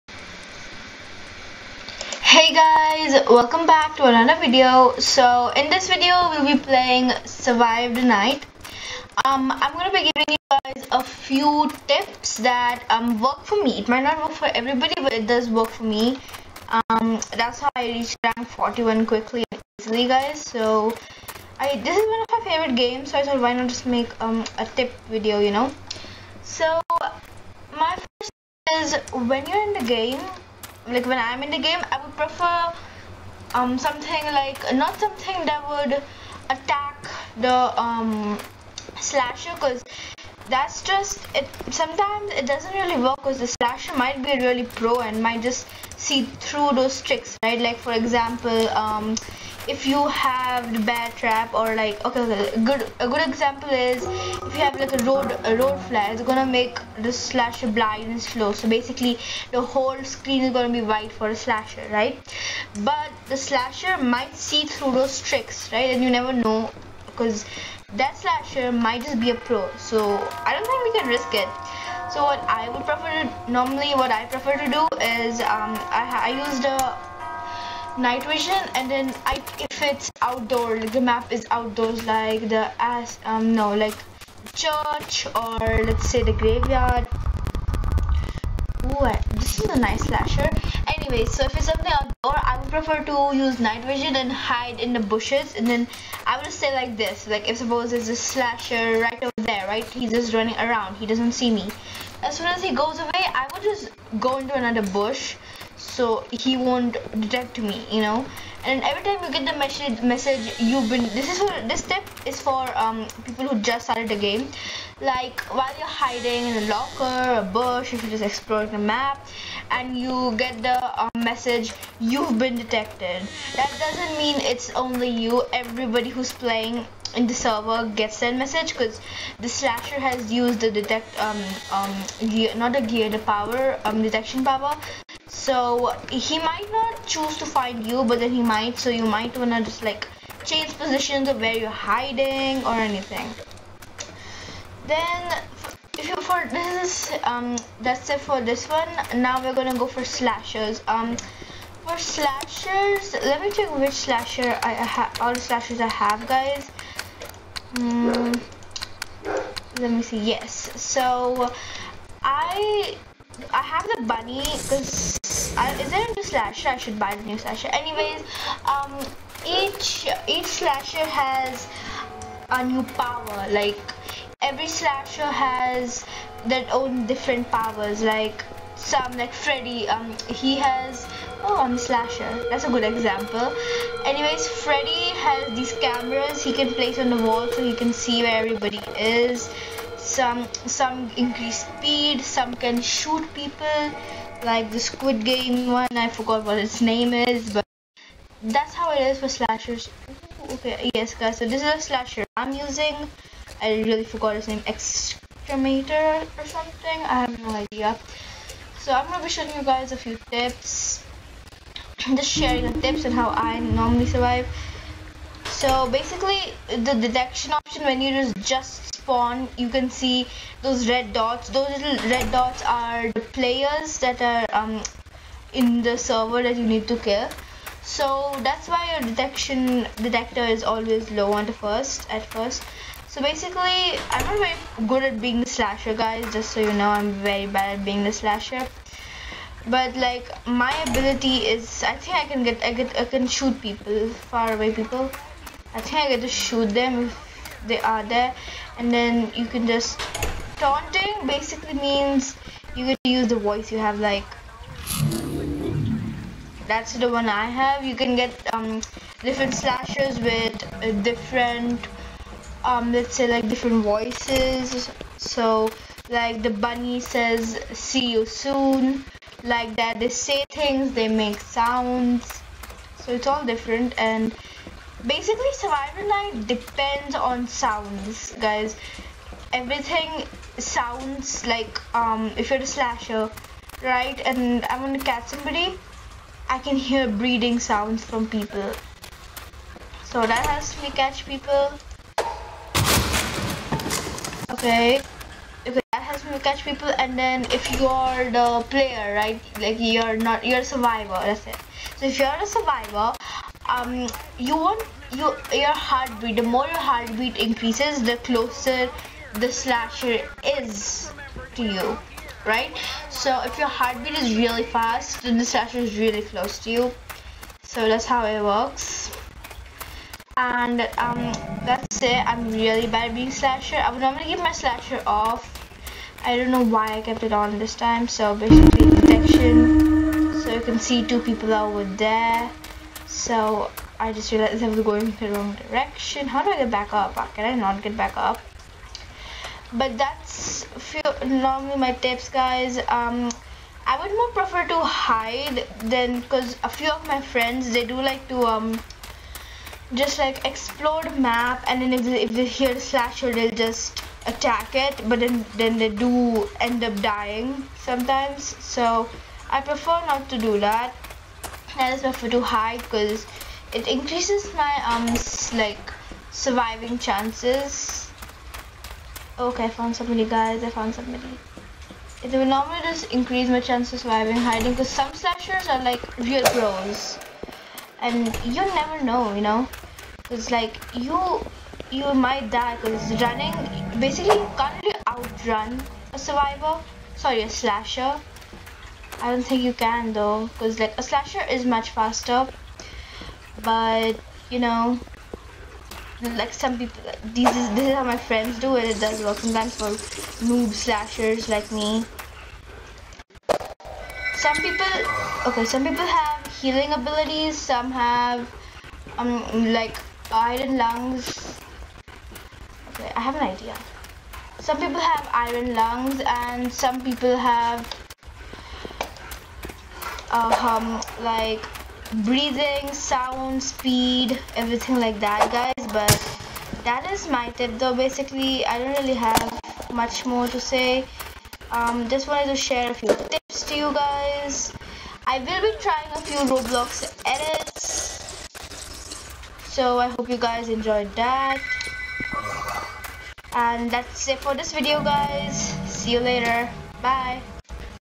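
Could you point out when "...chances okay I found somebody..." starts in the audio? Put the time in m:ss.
6:06.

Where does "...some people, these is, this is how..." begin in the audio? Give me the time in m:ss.
6:36.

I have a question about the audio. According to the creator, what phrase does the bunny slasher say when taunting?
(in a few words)
See you soon.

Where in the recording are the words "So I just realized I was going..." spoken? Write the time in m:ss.
5:33.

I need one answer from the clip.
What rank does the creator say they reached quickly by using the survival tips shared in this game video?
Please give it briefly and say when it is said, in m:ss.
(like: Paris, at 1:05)
41, at 0:18.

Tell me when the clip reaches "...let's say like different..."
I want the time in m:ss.
4:22.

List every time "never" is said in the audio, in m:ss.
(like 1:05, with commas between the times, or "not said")
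1:06, 6:18.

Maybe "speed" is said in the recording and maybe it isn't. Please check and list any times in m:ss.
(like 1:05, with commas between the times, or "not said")
3:11, 7:03.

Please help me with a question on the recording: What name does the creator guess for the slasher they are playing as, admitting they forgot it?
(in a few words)
Excremator.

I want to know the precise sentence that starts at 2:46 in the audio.
I should buy the new slasher.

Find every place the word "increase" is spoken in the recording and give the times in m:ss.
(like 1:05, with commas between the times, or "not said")
3:11, 5:07, 6:03, 6:13.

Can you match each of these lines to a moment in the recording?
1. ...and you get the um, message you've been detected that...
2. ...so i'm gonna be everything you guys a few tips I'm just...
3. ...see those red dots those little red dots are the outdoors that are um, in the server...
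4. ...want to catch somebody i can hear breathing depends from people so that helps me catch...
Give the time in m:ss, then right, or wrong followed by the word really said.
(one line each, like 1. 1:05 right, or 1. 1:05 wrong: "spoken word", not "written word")
1. 1:59 right
2. 3:28 wrong: "showing", not "everything"
3. 3:39 wrong: "players", not "outdoors"
4. 4:44 wrong: "sounds", not "depends".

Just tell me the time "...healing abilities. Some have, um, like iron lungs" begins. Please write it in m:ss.
6:46.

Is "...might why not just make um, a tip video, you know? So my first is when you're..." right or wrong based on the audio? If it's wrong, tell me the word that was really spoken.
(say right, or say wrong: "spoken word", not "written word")
wrong: "thought", not "might".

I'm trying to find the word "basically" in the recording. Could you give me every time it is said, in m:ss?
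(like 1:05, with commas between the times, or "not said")
0:58, 3:35, 3:53, 4:11, 4:35, 5:28, 6:23, 7:07.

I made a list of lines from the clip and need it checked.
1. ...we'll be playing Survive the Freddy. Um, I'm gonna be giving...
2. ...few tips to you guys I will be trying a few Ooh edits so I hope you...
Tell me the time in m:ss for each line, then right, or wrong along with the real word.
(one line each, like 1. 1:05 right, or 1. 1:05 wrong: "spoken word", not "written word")
1. 0:06 wrong: "Night", not "Freddy"
2. 7:12 wrong: "Roblox", not "Ooh".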